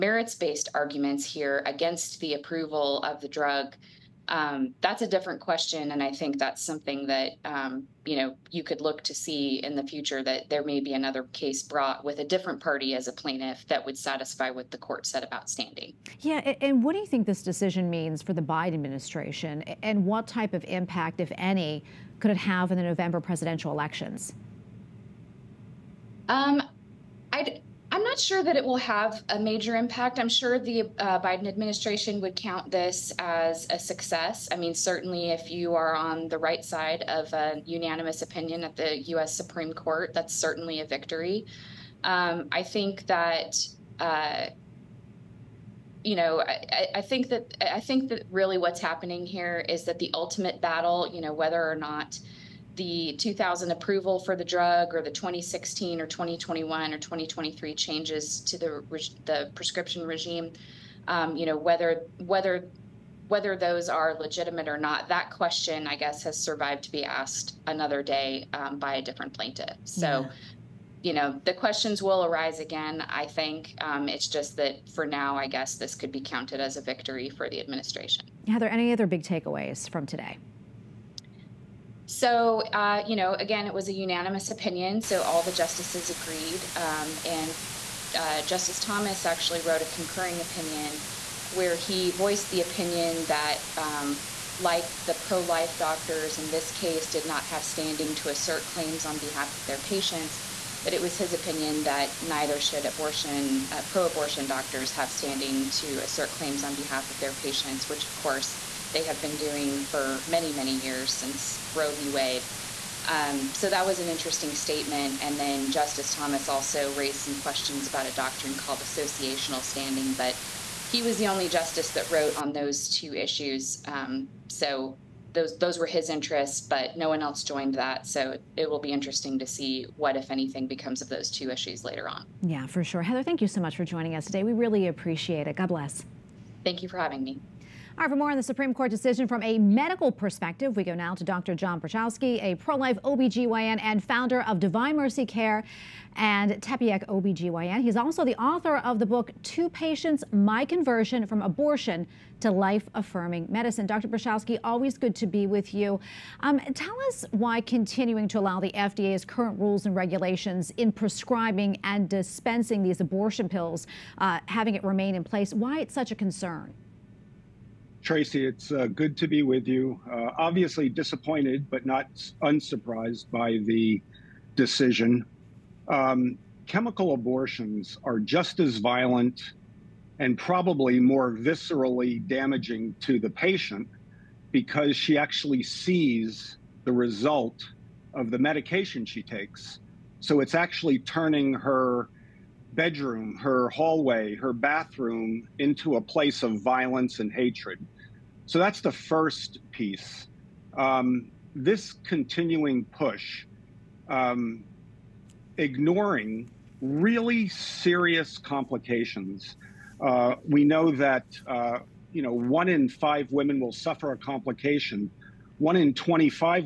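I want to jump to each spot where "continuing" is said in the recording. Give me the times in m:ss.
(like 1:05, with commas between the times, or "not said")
2:37, 3:22.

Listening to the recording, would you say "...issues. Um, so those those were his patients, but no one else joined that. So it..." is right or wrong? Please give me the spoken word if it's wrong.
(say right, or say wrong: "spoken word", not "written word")
wrong: "interests", not "patients".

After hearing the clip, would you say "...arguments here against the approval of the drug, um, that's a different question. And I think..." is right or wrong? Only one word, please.
right.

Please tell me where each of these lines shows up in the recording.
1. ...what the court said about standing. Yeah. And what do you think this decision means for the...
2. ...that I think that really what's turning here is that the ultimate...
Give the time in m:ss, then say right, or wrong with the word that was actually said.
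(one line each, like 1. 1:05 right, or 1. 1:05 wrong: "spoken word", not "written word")
1. 0:14 right
2. 0:47 wrong: "happening", not "turning".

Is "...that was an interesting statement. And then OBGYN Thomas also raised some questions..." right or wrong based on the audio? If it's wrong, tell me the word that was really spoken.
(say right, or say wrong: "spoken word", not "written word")
wrong: "Justice", not "OBGYN".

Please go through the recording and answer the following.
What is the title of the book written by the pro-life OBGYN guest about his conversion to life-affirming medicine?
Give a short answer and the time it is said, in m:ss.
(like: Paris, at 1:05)
Two Patients, at 2:29.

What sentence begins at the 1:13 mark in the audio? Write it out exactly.
Um, it's just that for now, I guess this could be counted as a victory for the administration.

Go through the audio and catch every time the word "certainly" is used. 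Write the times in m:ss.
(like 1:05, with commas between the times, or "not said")
0:34, 0:40.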